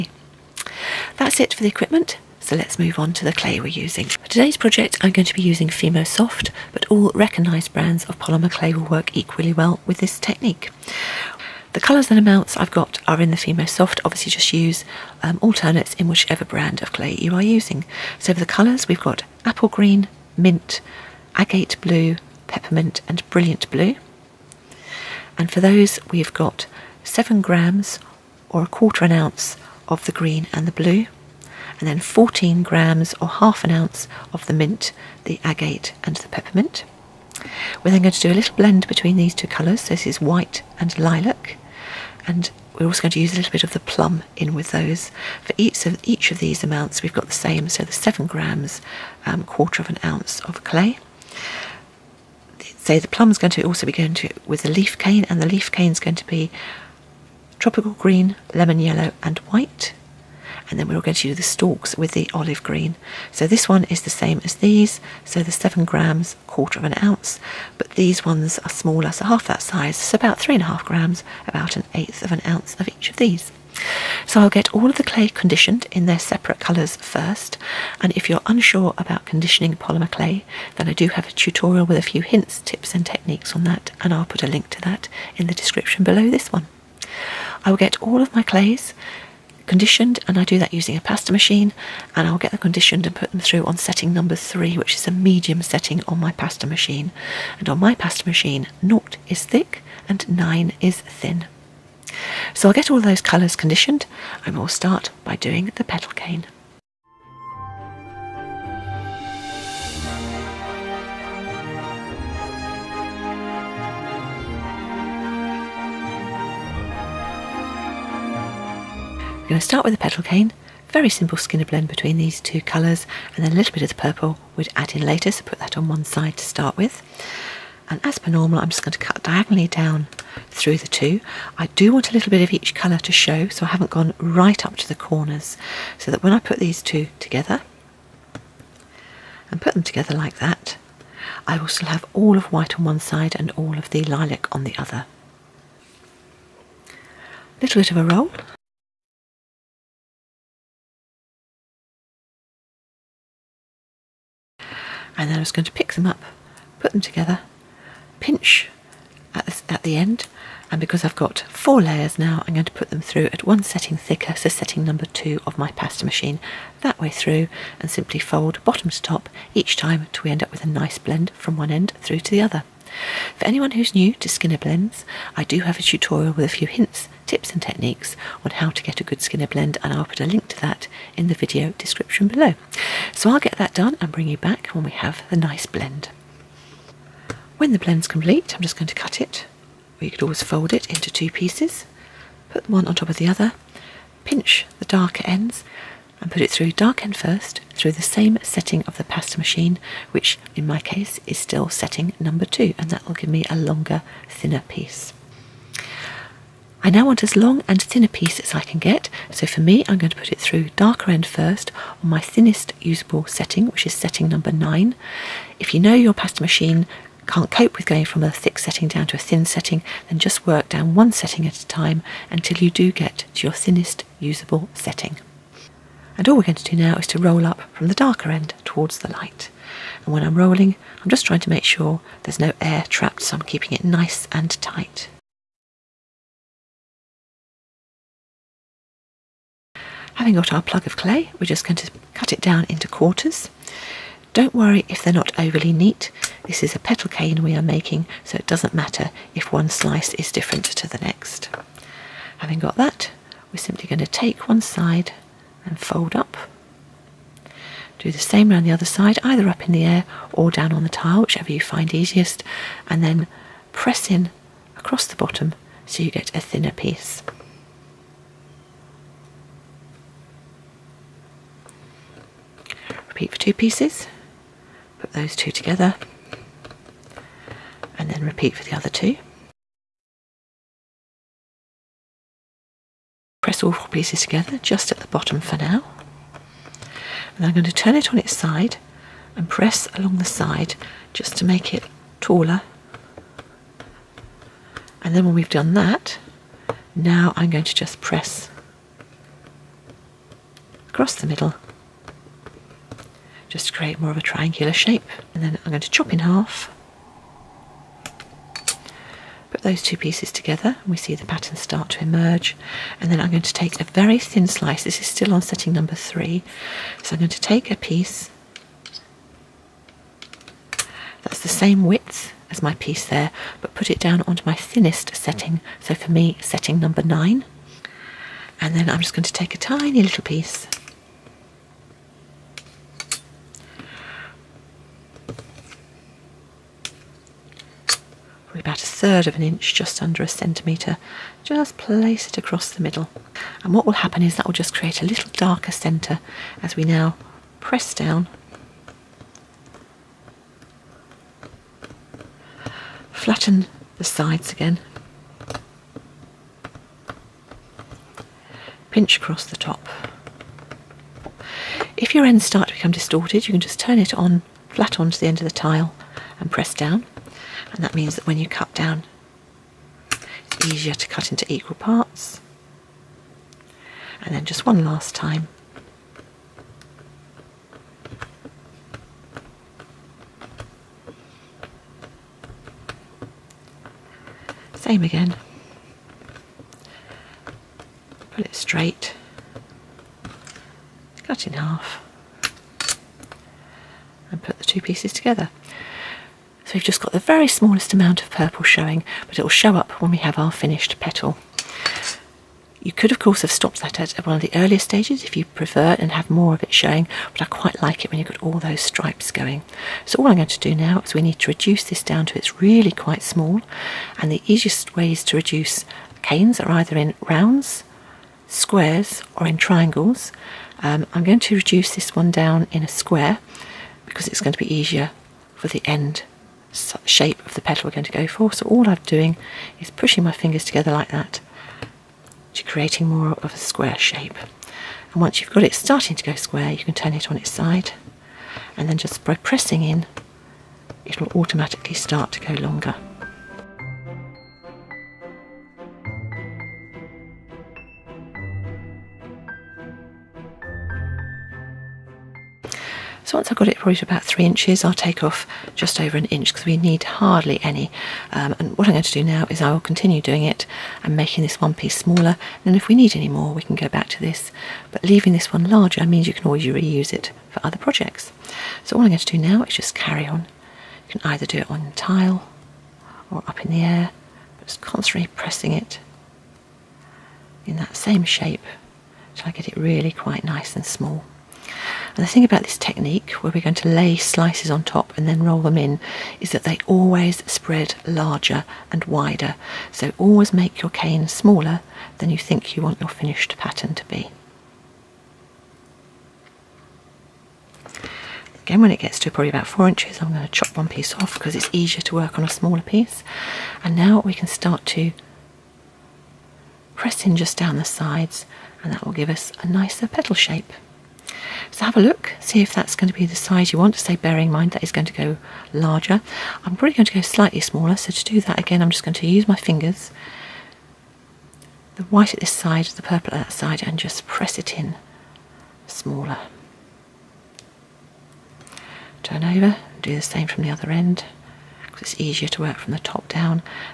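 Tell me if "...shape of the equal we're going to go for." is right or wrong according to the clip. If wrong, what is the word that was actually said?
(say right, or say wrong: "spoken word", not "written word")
wrong: "petal", not "equal".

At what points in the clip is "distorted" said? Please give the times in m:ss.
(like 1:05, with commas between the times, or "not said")
6:02.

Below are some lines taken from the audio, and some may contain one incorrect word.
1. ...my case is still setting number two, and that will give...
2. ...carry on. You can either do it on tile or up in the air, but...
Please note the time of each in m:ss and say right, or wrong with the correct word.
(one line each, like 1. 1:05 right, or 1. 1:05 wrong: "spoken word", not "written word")
1. 3:20 right
2. 7:49 right.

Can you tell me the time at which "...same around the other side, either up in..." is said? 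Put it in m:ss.
4:18.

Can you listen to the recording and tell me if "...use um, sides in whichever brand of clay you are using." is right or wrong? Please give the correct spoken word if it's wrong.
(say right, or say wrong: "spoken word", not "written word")
wrong: "alternates", not "sides".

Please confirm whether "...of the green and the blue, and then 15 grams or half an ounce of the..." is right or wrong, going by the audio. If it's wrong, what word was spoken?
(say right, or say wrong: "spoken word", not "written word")
wrong: "14", not "15".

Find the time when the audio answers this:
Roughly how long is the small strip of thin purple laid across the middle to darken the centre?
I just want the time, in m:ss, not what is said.
5:38.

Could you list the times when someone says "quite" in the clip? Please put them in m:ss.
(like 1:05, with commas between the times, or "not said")
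6:47, 6:52, 8:00.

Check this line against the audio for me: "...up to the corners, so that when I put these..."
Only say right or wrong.
right.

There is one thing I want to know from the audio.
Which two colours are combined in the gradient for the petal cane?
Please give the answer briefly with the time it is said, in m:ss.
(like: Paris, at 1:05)
white and lilac, at 0:40.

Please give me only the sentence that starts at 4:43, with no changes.
Press all four pieces together just at the bottom for now.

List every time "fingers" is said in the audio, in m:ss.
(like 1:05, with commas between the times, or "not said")
7:10, 8:39.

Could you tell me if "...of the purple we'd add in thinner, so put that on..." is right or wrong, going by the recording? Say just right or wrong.
wrong.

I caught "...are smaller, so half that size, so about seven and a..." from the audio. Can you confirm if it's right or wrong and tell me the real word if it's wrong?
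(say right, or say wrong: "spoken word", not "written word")
wrong: "three", not "seven".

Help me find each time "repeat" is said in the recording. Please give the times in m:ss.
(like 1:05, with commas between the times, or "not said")
4:33, 4:38.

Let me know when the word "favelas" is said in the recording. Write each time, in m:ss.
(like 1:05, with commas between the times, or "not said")
not said.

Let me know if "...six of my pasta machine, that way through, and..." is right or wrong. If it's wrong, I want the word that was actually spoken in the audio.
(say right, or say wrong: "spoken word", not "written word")
wrong: "two", not "six".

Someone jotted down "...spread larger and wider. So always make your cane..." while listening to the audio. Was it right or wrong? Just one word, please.
right.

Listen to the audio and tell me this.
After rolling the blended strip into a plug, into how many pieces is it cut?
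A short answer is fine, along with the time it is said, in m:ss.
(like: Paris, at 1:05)
quarters, at 4:02.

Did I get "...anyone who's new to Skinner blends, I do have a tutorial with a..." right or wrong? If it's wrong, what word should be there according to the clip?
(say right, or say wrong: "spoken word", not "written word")
right.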